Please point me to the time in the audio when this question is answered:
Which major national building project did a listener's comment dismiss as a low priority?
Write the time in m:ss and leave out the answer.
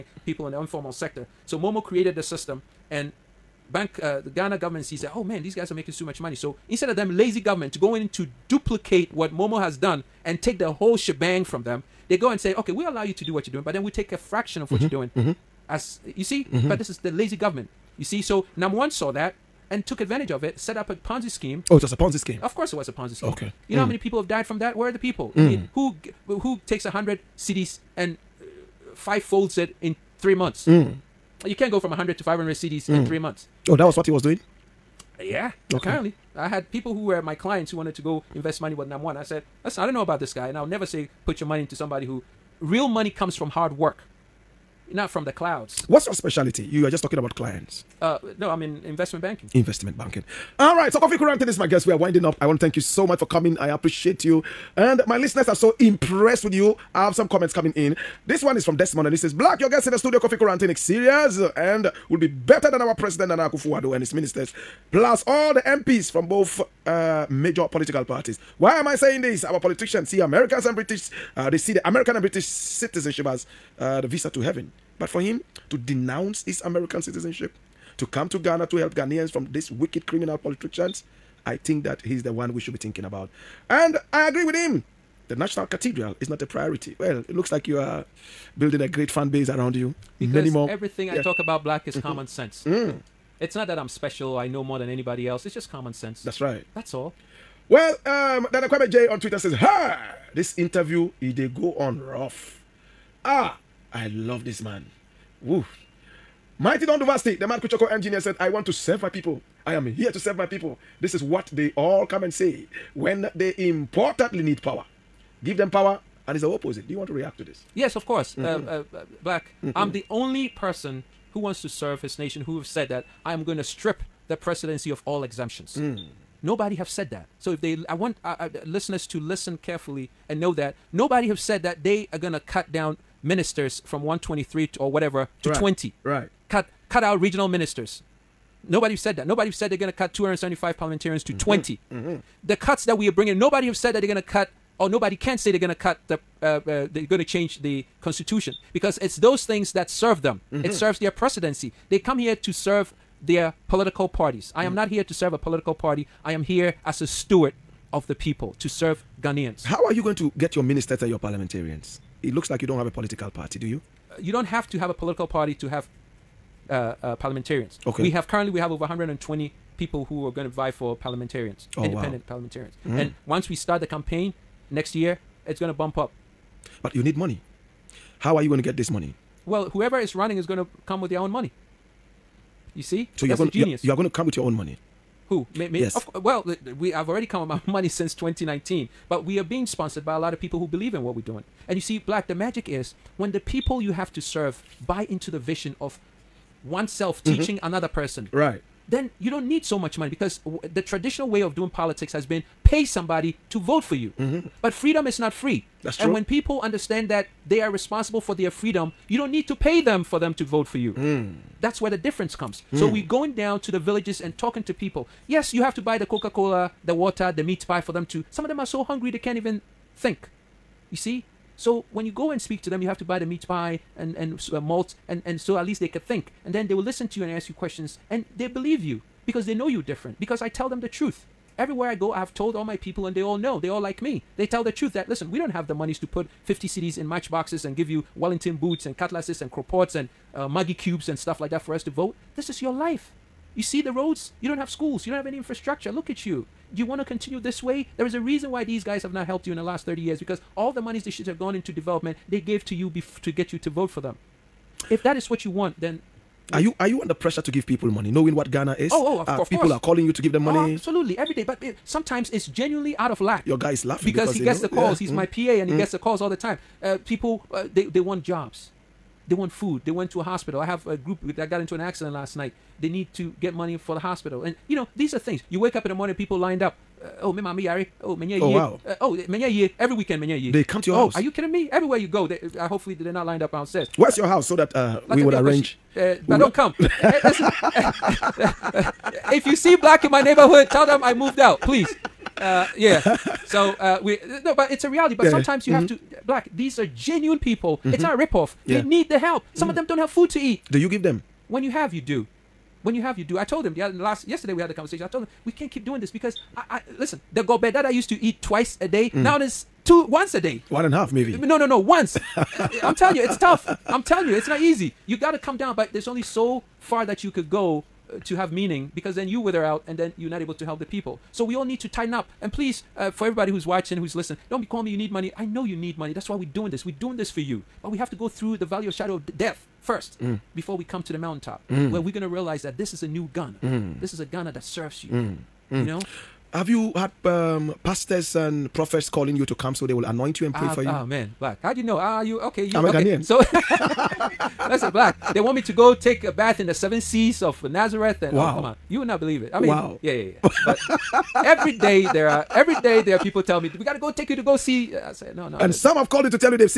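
1:25.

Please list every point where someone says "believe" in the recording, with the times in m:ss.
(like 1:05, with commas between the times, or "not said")
3:10, 3:48, 5:49.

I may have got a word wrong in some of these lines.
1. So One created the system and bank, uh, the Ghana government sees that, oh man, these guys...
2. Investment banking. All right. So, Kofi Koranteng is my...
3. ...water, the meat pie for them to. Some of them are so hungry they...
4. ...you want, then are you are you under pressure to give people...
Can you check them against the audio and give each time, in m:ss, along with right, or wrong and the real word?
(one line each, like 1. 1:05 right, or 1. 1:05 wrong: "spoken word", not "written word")
1. 0:01 wrong: "Momo", not "One"
2. 0:49 right
3. 3:36 right
4. 4:15 right.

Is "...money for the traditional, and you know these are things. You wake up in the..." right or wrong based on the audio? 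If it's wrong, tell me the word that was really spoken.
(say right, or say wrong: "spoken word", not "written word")
wrong: "hospital", not "traditional".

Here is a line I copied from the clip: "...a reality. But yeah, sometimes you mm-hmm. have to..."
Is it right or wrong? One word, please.
right.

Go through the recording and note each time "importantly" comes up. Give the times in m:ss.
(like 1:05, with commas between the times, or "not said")
1:53.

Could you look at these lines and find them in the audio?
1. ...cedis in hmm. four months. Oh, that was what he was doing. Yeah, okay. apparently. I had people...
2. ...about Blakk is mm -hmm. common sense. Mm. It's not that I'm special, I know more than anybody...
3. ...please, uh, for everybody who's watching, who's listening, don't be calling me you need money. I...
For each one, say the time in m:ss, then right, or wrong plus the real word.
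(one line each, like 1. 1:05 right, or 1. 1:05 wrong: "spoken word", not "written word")
1. 0:32 wrong: "three", not "four"
2. 1:31 right
3. 5:22 right.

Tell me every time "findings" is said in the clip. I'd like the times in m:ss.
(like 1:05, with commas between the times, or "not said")
not said.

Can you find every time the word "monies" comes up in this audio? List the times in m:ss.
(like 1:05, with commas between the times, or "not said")
3:55, 4:10.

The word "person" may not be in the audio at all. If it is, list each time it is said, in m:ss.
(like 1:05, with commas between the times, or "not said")
2:00, 3:17.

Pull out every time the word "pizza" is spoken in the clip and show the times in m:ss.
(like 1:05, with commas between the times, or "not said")
not said.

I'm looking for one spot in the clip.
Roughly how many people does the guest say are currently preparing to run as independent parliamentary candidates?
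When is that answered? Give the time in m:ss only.
2:48.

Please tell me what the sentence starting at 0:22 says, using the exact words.
Of course, it was a Ponzi scheme.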